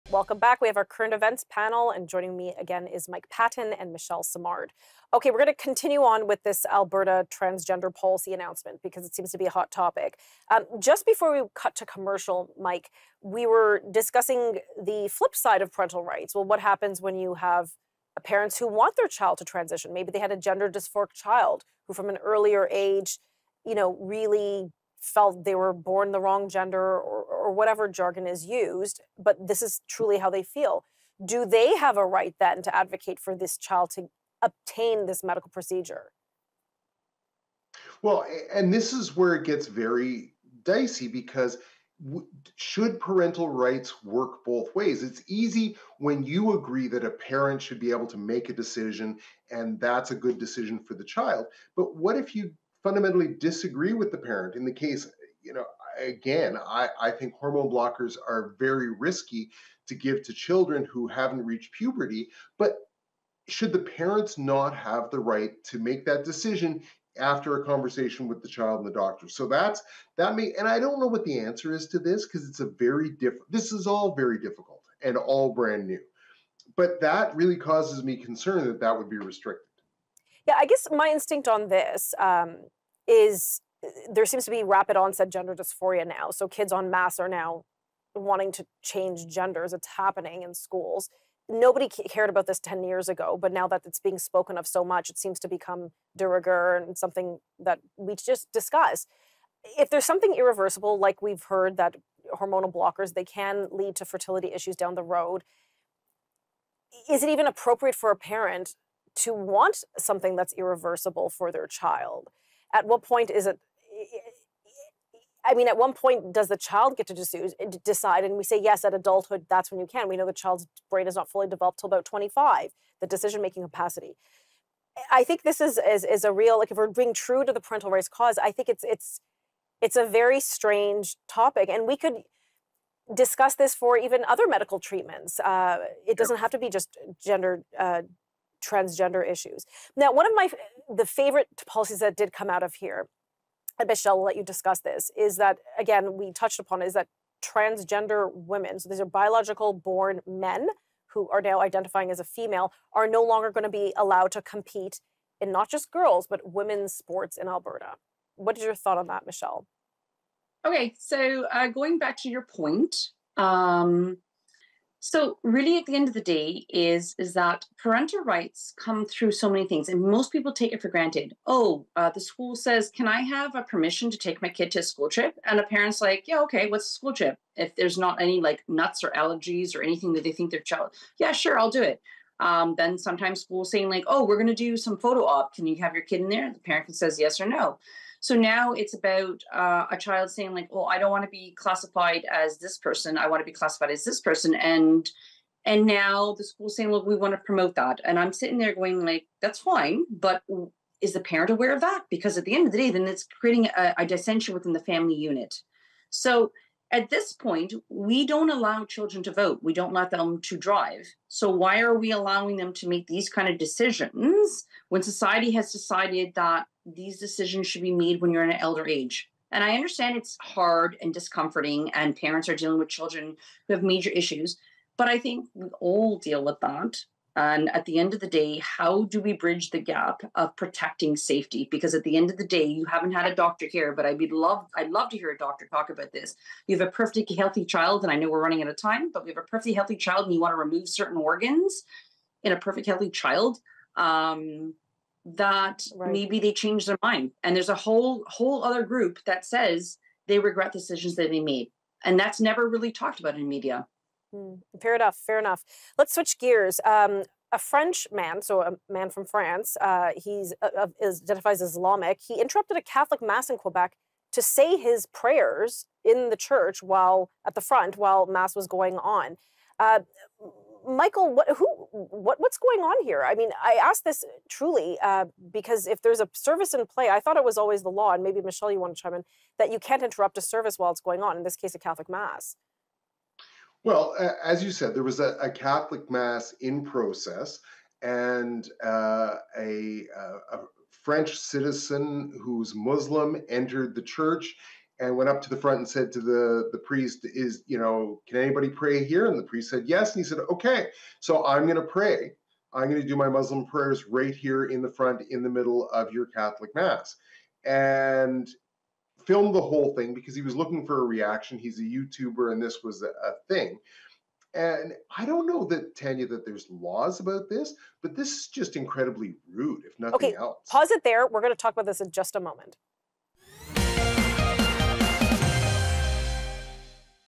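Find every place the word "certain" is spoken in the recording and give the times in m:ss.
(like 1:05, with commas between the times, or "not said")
4:00.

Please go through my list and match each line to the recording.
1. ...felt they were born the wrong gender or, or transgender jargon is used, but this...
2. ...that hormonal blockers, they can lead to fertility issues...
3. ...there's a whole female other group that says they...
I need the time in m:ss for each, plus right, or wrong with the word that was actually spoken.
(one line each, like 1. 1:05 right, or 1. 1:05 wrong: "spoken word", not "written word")
1. 0:25 wrong: "whatever", not "transgender"
2. 1:41 right
3. 4:07 wrong: "whole", not "female".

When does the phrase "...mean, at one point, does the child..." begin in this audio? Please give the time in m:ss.
1:55.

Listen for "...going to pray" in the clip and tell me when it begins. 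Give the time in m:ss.
5:01.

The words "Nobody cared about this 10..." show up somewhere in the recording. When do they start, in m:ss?
1:31.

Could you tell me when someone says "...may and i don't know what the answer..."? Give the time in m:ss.
1:10.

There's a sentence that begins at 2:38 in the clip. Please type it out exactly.
What is your thought on that, Michelle?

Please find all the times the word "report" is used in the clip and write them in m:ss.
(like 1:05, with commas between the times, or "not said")
not said.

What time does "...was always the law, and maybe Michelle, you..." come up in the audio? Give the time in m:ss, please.
4:37.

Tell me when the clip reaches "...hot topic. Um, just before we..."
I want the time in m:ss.
0:09.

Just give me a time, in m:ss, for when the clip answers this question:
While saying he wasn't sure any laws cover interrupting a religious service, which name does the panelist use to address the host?
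5:15.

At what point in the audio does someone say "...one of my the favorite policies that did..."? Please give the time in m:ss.
2:20.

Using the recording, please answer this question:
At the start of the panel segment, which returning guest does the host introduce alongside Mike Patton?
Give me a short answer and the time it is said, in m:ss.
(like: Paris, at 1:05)
Michelle Simard, at 0:03.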